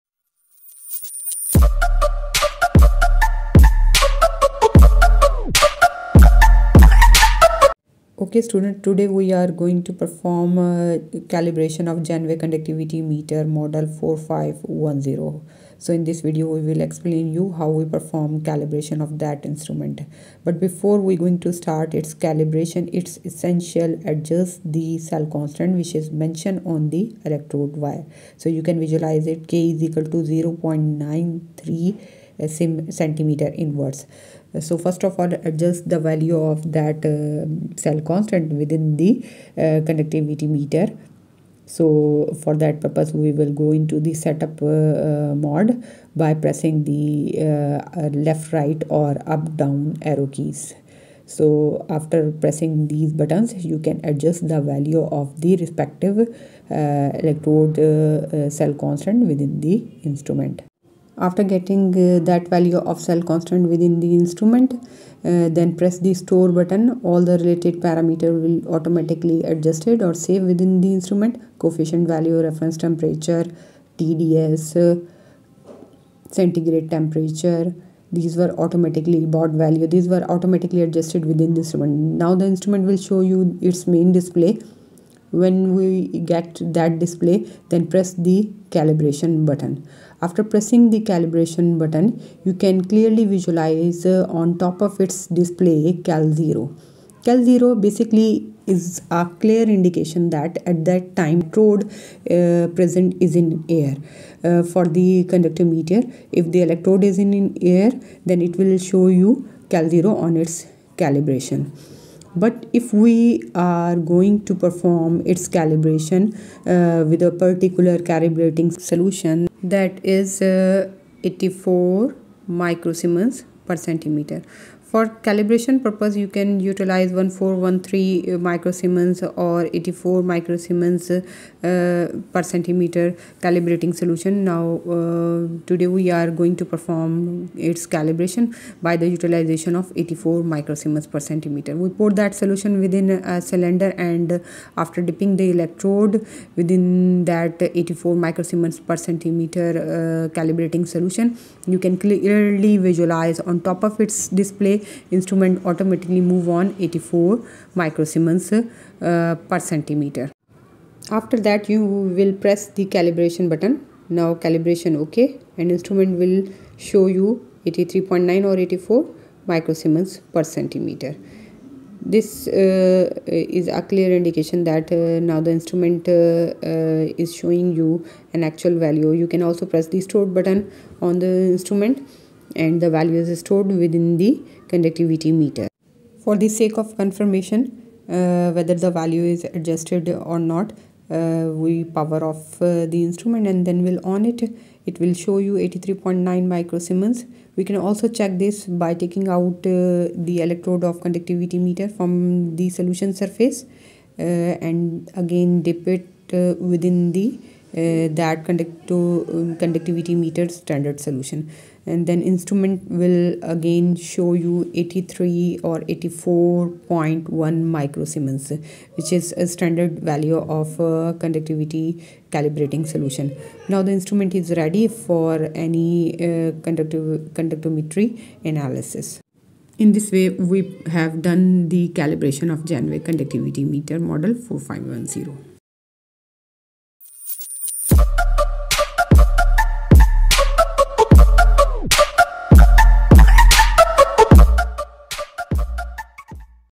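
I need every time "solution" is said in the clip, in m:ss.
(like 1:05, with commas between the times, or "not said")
1:58, 2:13, 2:22, 2:30, 3:22, 3:31, 3:42.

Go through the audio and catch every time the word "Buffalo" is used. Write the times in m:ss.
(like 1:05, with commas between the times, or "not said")
not said.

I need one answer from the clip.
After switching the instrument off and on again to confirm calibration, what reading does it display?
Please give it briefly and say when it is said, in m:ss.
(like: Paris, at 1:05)
83.9 microsiemens, at 3:15.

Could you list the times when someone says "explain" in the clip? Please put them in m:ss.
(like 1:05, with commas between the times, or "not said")
0:16.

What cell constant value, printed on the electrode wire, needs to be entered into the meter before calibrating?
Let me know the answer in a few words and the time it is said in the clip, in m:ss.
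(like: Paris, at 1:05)
0.93, at 0:30.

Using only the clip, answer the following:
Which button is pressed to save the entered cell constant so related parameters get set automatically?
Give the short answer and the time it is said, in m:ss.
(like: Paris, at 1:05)
store, at 1:06.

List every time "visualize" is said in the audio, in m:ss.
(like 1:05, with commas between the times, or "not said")
0:28, 1:33, 2:32.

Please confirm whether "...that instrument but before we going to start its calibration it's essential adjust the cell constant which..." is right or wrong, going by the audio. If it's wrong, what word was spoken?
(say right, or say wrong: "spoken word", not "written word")
right.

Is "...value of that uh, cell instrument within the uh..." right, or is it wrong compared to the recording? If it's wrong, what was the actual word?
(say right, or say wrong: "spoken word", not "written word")
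wrong: "constant", not "instrument".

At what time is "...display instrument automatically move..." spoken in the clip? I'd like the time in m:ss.
2:34.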